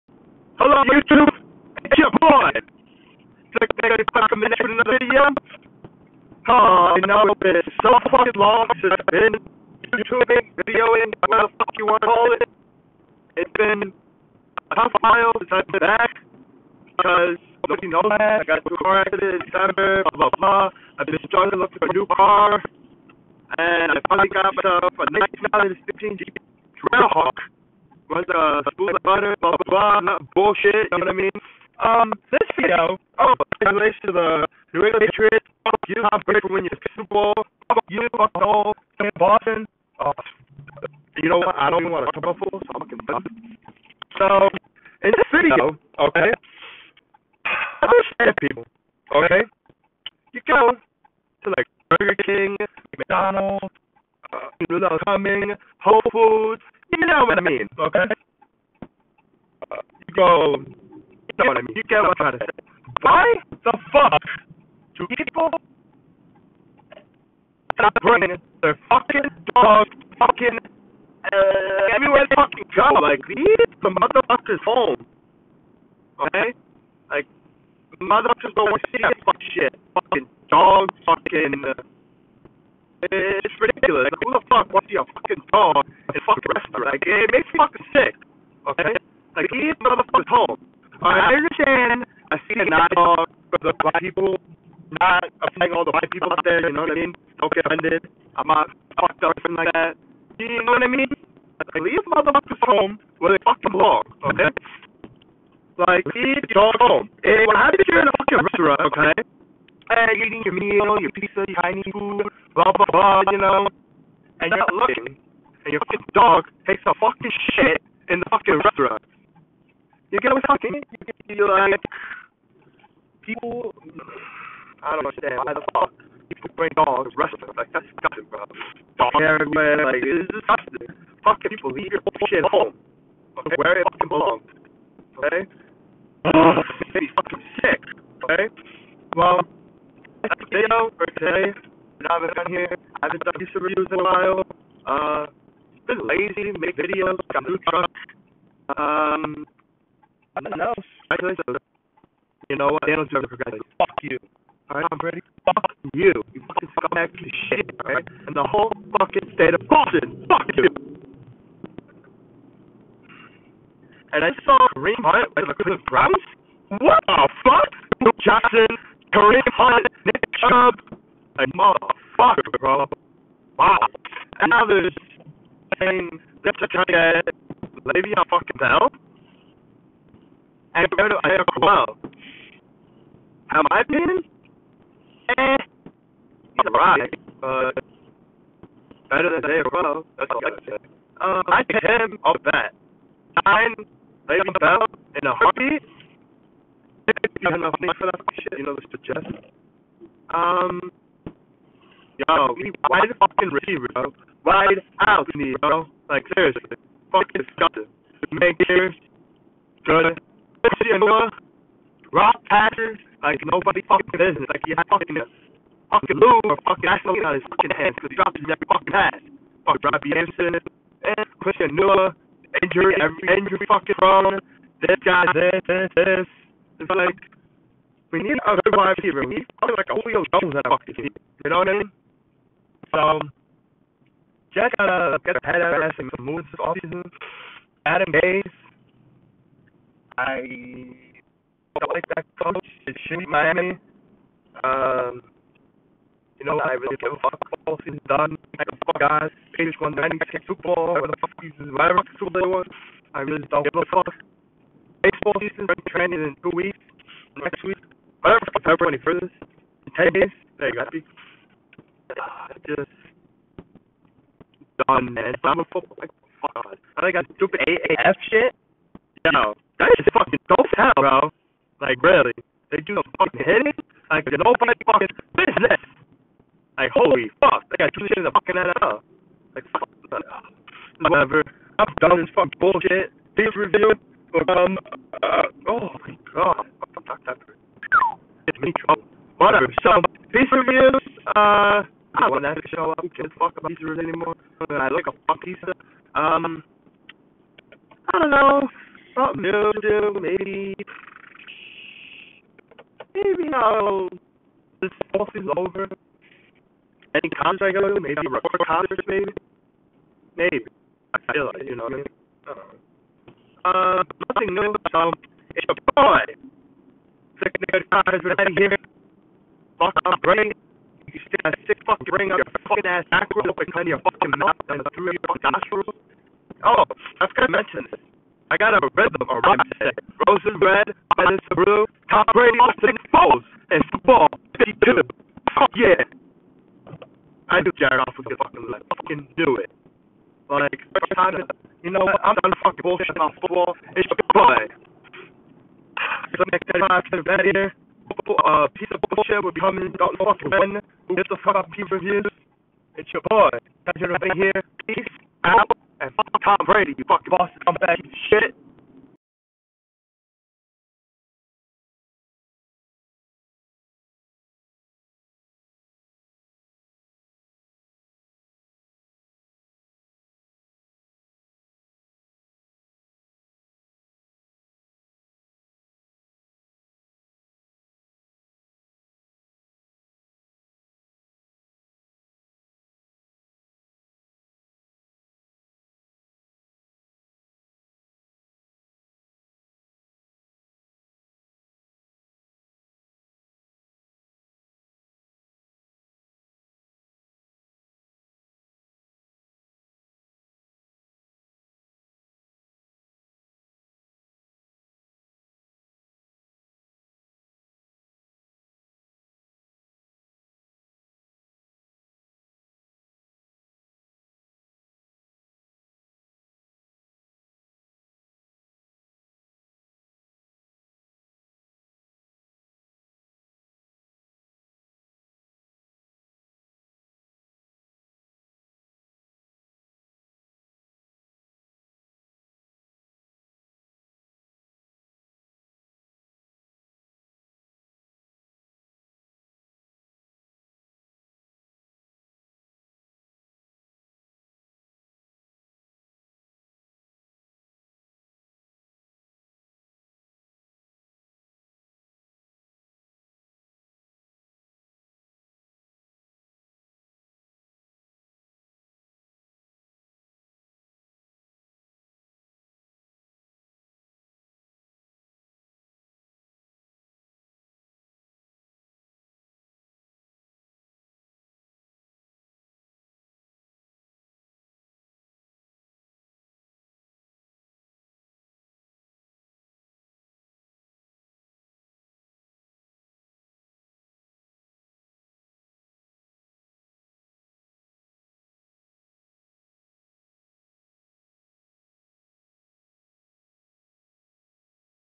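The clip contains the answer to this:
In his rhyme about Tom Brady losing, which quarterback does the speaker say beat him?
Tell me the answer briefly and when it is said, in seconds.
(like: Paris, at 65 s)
Nick Foles, at 332 s.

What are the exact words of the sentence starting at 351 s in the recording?
Get the fuck up, people reviews.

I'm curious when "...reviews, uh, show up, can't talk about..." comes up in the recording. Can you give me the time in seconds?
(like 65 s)
290 s.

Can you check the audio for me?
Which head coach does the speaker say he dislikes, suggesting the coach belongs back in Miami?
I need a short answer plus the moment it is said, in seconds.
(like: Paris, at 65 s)
Adam Gase, at 237 s.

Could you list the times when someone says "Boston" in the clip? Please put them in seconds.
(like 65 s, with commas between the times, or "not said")
39 s, 159 s.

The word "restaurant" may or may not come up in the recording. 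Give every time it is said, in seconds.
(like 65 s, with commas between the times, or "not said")
86 s, 108 s, 118 s, 127 s.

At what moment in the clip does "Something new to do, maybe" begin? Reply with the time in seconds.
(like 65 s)
299 s.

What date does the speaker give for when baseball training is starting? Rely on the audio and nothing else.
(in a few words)
February 21st.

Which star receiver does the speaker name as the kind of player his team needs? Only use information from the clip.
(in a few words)
Julio Jones.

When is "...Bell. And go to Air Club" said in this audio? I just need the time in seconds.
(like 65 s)
178 s.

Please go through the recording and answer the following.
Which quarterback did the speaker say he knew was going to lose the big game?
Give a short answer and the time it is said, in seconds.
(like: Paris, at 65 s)
Jared Goff, at 337 s.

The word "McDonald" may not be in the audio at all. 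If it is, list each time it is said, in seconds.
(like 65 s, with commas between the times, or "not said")
52 s.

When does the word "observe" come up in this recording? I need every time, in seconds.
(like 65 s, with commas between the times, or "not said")
not said.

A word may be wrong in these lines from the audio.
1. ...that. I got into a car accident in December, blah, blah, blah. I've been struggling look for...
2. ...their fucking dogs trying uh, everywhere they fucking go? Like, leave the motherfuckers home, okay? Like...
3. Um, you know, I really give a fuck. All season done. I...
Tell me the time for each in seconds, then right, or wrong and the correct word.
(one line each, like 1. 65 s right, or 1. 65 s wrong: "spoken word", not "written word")
1. 18 s right
2. 68 s wrong: "fucking", not "trying"
3. 244 s right.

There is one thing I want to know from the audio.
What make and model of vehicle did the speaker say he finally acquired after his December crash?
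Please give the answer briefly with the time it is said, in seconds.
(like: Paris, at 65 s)
Jeep Trailhawk, at 26 s.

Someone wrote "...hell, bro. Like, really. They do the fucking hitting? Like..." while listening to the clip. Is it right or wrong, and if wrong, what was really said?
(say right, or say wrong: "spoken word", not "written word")
right.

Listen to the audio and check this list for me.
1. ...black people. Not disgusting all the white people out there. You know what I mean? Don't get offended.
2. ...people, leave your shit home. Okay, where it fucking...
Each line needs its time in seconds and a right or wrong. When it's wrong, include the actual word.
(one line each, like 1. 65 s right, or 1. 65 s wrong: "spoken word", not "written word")
1. 93 s wrong: "offending", not "disgusting"
2. 131 s right.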